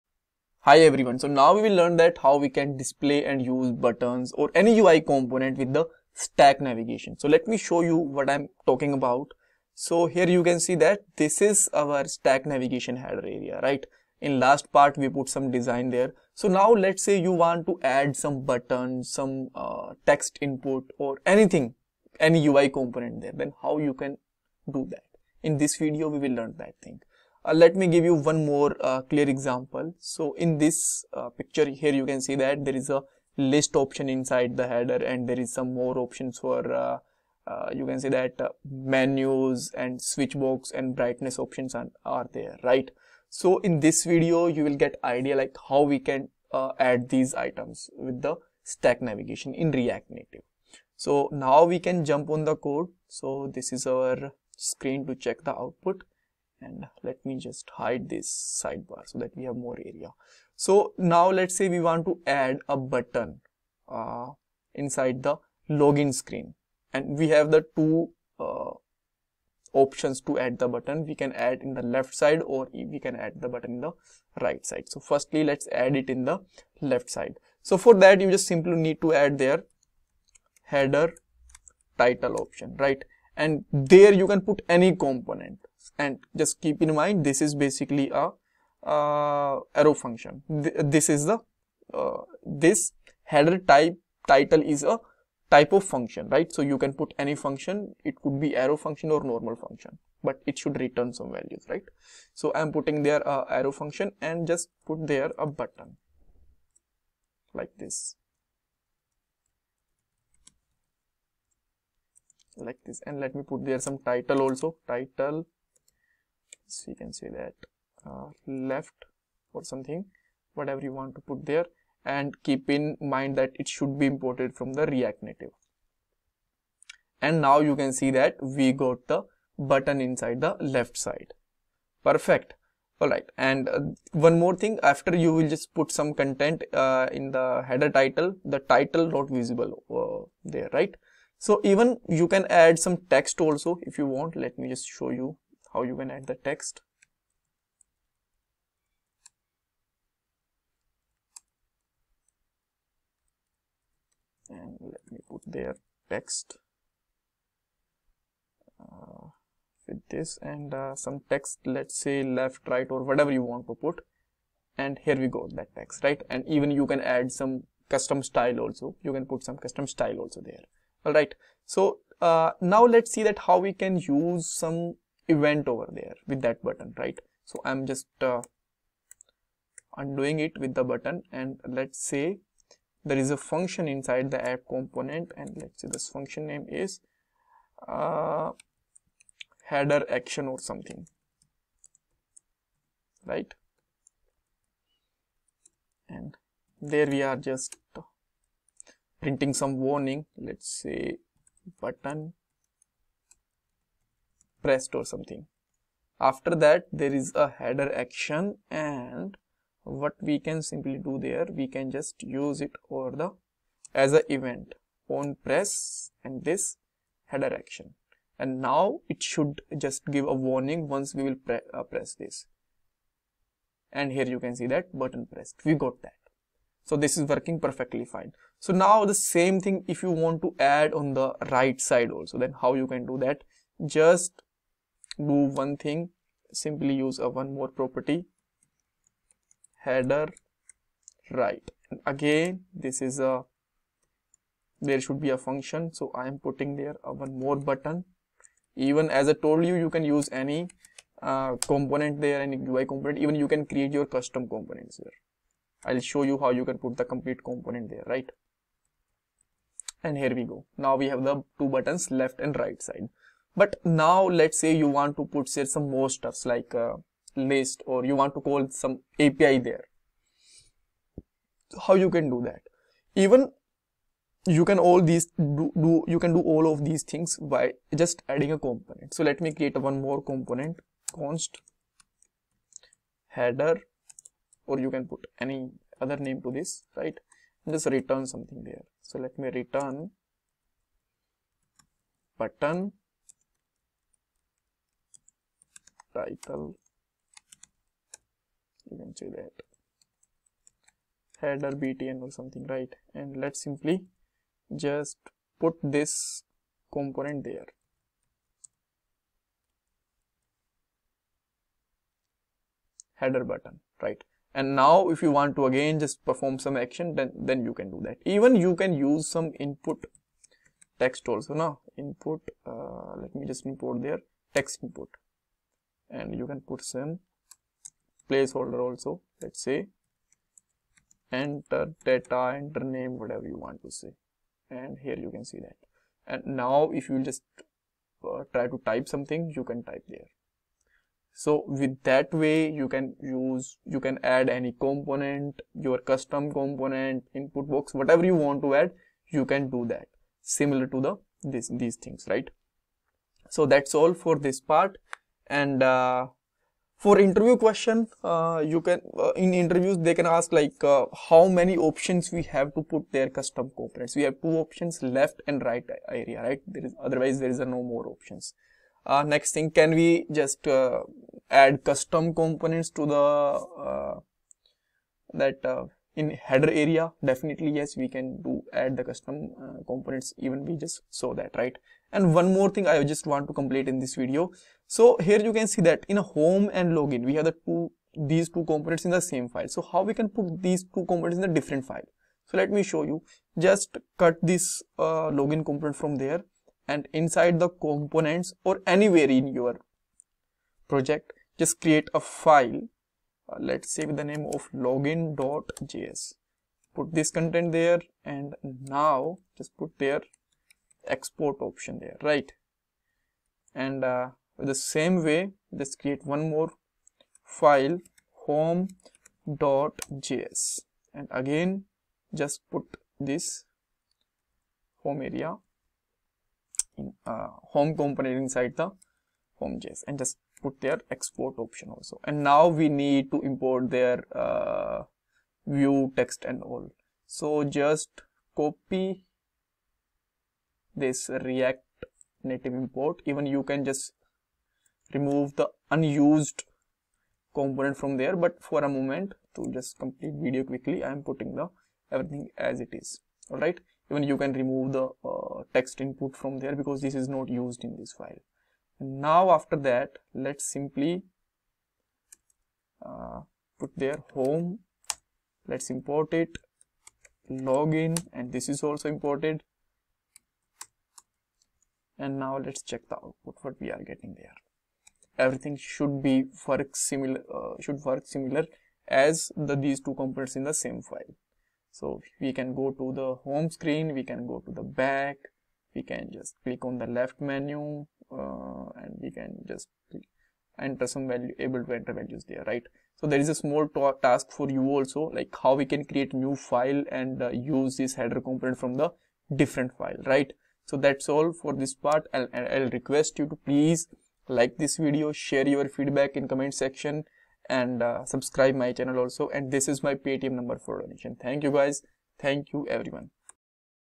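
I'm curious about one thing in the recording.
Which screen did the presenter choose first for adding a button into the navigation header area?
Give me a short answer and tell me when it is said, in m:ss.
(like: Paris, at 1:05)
login screen, at 1:05.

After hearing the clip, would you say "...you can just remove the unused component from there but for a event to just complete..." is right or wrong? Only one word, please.
wrong.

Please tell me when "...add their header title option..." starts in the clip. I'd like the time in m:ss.
1:19.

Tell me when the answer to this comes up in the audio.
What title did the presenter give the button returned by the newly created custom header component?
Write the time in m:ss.
5:01.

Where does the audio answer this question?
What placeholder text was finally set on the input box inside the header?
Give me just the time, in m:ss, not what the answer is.
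5:32.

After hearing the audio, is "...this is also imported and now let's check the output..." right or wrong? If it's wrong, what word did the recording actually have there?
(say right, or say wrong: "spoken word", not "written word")
right.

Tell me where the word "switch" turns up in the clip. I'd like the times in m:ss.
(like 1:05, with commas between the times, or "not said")
0:39.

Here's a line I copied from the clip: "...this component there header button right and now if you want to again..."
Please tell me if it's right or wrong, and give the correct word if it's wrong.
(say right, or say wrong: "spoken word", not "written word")
right.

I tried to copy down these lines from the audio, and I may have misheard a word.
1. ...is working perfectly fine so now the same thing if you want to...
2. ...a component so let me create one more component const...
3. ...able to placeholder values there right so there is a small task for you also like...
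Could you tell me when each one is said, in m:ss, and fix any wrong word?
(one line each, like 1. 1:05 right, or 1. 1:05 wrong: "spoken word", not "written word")
1. 3:47 right
2. 4:38 right
3. 8:11 wrong: "enter", not "placeholder".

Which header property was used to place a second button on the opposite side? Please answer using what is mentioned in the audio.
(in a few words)
header right.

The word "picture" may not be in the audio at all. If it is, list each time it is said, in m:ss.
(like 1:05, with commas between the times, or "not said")
0:31.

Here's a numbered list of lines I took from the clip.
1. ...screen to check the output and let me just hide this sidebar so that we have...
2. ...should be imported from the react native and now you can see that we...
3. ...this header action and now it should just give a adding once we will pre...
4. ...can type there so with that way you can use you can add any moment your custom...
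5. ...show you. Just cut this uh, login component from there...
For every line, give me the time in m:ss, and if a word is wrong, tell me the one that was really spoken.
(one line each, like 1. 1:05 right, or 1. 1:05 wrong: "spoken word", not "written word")
1. 0:54 right
2. 2:03 right
3. 3:36 wrong: "warning", not "adding"
4. 5:39 wrong: "component", not "moment"
5. 6:32 right.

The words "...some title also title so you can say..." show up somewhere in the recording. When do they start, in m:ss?
1:53.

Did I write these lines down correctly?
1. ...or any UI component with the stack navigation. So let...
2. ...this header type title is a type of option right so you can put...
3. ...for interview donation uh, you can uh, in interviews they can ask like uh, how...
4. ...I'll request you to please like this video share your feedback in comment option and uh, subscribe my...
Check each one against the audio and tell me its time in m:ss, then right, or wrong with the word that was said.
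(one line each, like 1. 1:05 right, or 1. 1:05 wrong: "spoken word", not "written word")
1. 0:04 right
2. 1:32 wrong: "function", not "option"
3. 5:56 wrong: "question", not "donation"
4. 8:22 wrong: "section", not "option".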